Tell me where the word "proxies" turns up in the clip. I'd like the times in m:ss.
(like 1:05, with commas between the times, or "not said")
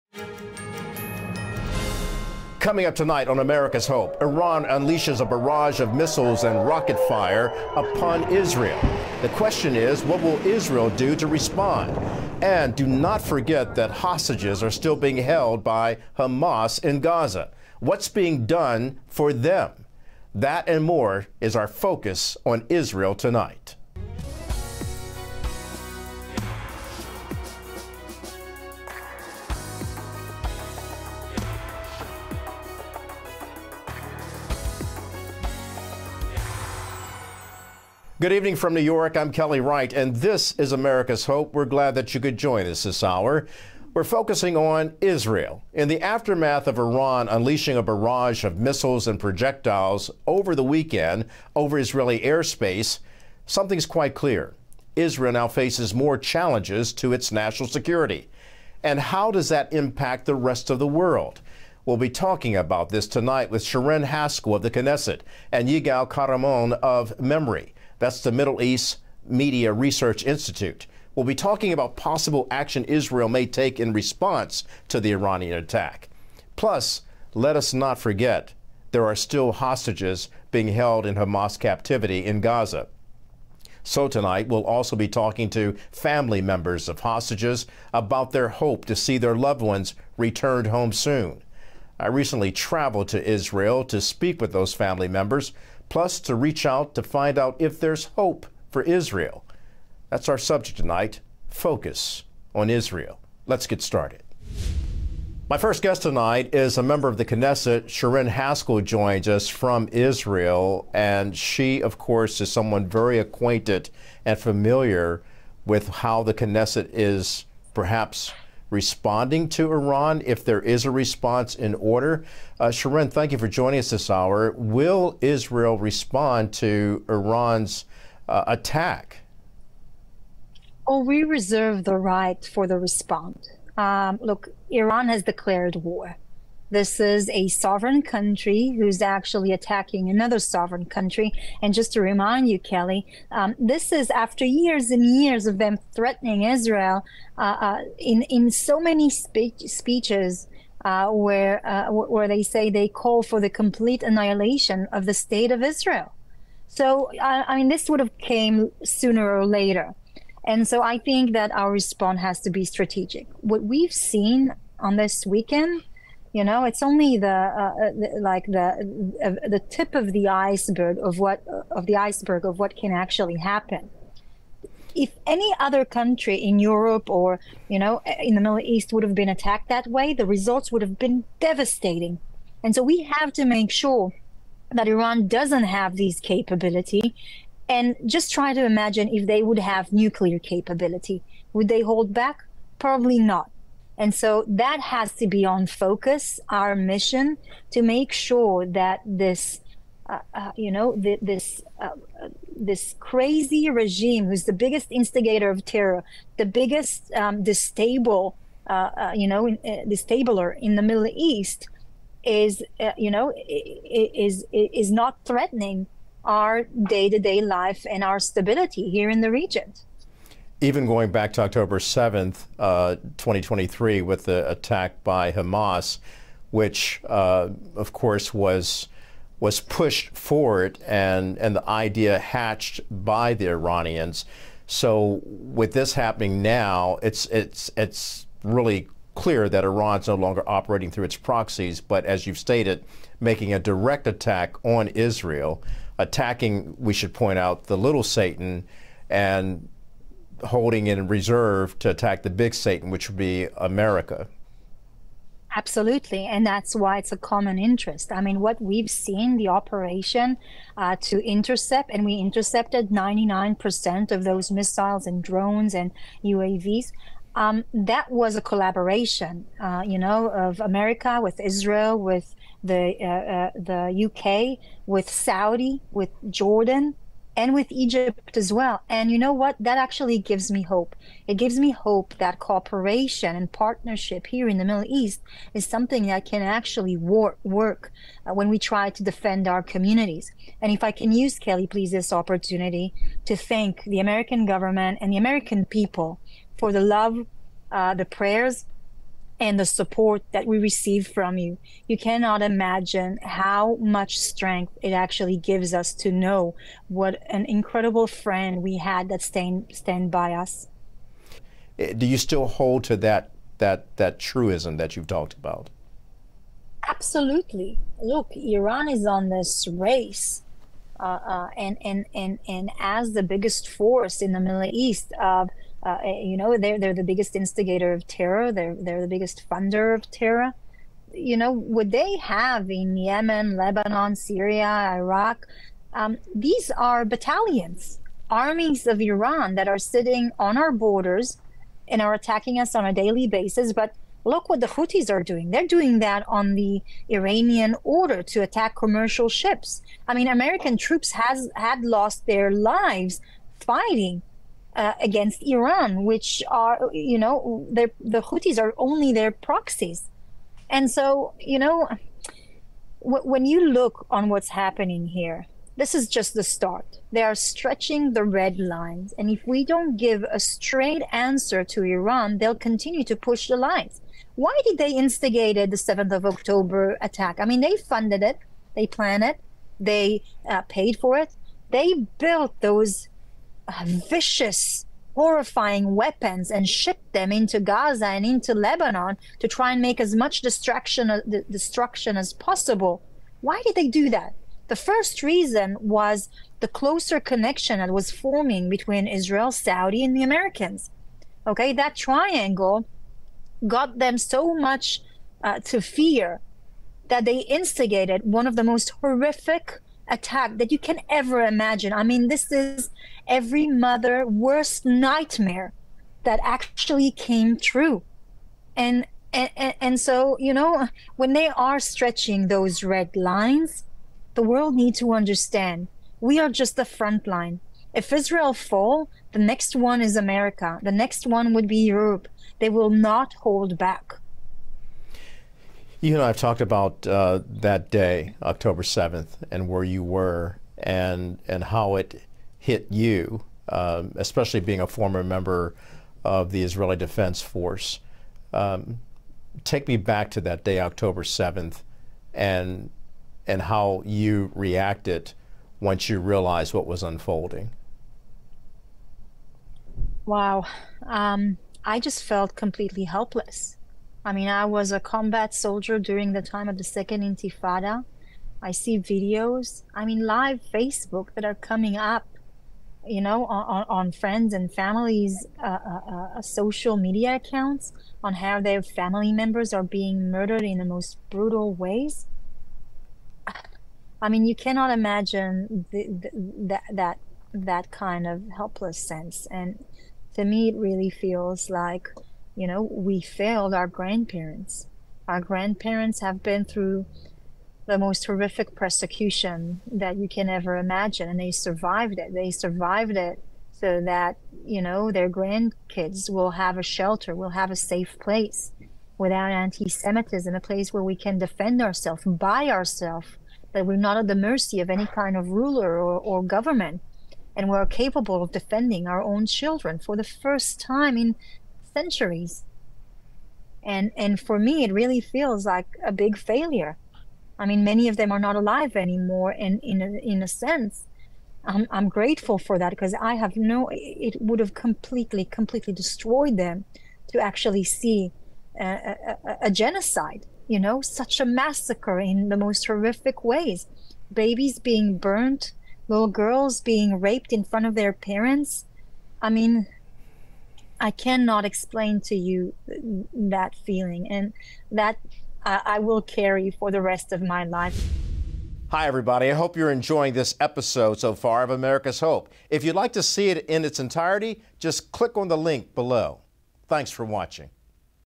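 4:01, 5:59.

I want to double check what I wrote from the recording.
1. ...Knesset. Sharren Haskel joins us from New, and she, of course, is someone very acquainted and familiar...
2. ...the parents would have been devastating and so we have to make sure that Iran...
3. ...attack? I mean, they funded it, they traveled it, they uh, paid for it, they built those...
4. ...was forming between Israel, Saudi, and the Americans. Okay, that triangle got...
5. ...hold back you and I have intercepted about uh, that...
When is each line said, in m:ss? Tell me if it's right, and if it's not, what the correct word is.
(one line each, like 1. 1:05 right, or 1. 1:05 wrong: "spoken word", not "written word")
1. 1:47 wrong: "Israel", not "New"
2. 3:00 wrong: "results", not "parents"
3. 6:17 wrong: "planned", not "traveled"
4. 6:37 right
5. 7:13 wrong: "talked", not "intercepted".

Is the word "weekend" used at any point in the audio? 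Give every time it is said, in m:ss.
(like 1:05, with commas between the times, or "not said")
0:50, 2:45.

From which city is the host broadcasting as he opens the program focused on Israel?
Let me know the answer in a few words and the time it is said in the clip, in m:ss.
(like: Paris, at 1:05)
New York, at 0:38.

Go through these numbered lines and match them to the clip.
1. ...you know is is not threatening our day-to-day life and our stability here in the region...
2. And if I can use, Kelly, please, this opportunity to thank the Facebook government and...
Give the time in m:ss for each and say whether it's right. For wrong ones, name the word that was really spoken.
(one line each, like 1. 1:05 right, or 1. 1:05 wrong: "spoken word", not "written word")
1. 3:32 right
2. 4:50 wrong: "American", not "Facebook".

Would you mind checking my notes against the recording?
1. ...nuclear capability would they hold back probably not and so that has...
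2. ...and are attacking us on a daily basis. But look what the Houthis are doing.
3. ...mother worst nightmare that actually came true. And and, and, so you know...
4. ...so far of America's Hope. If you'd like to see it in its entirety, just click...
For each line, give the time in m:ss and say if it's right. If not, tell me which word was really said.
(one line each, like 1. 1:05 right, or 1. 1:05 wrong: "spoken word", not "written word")
1. 3:09 right
2. 5:41 right
3. 6:53 right
4. 9:21 right.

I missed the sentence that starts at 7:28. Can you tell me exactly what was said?
Um, take me back to that day, October 7th, and, and how you reacted once you realized what was unfolding.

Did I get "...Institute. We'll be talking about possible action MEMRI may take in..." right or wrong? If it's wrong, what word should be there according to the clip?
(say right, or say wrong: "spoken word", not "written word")
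wrong: "Israel", not "MEMRI".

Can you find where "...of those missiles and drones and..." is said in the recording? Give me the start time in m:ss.
4:24.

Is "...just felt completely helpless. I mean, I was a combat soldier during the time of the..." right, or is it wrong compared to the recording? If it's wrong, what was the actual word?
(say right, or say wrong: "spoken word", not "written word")
right.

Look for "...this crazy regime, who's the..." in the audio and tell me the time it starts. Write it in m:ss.
3:22.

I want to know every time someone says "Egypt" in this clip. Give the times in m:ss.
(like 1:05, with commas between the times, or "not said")
4:37.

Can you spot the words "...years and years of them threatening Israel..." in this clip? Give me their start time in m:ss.
2:24.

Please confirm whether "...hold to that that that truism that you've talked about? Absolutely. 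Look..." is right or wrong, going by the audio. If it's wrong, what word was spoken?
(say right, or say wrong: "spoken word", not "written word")
right.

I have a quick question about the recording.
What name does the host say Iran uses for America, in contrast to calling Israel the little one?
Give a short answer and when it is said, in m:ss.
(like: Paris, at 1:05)
big Satan, at 4:12.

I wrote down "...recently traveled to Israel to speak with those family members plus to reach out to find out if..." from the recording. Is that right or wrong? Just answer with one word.
right.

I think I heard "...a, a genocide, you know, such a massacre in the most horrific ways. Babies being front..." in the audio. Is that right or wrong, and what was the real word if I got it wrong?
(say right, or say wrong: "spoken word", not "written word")
wrong: "burnt", not "front".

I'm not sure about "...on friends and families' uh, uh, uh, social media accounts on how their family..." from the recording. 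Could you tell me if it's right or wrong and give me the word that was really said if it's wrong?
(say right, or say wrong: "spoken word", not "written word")
right.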